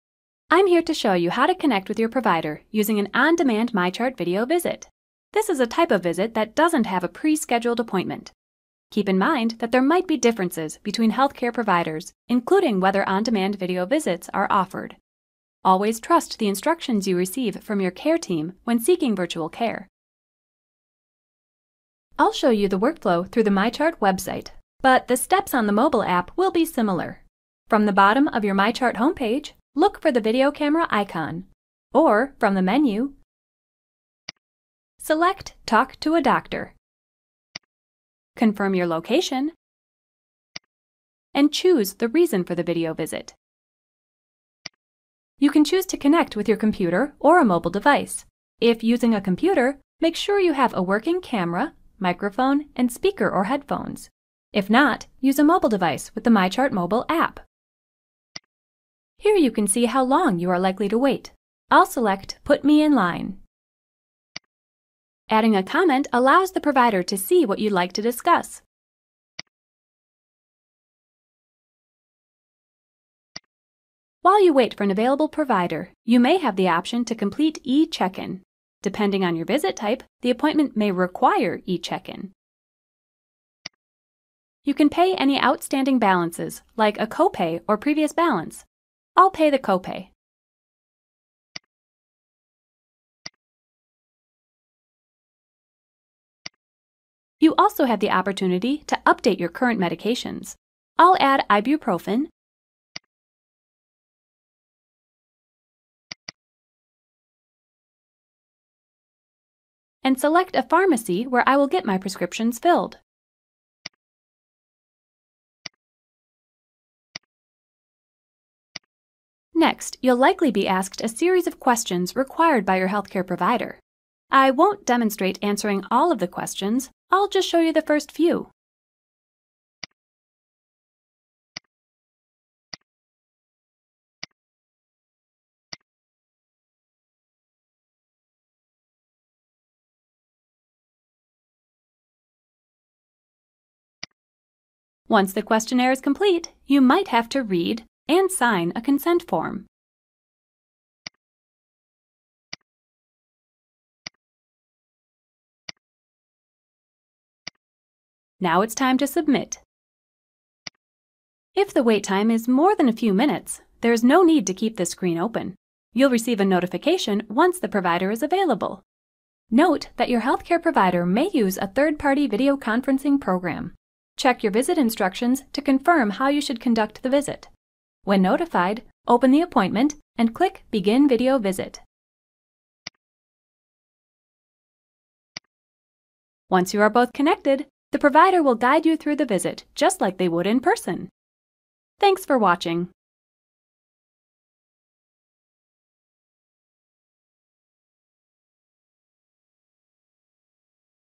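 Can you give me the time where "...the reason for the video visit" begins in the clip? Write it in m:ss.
0:41.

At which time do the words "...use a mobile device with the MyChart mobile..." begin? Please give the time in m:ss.
0:55.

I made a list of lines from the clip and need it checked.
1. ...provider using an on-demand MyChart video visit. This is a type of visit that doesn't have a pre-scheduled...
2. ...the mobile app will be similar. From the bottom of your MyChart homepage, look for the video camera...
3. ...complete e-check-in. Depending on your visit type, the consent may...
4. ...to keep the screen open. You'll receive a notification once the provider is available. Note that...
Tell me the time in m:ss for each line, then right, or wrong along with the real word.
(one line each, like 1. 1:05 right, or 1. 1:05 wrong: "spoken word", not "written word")
1. 0:02 right
2. 0:25 right
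3. 1:17 wrong: "appointment", not "consent"
4. 2:44 right.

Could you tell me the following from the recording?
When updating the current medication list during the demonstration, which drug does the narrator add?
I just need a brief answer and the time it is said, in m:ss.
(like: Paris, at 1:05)
ibuprofen, at 1:41.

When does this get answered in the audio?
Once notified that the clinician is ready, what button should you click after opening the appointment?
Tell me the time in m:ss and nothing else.
3:00.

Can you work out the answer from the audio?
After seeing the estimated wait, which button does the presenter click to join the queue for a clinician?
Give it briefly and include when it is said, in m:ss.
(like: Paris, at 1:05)
Put Me in Line, at 1:02.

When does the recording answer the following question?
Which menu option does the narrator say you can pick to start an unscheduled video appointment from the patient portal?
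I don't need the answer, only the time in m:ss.
0:35.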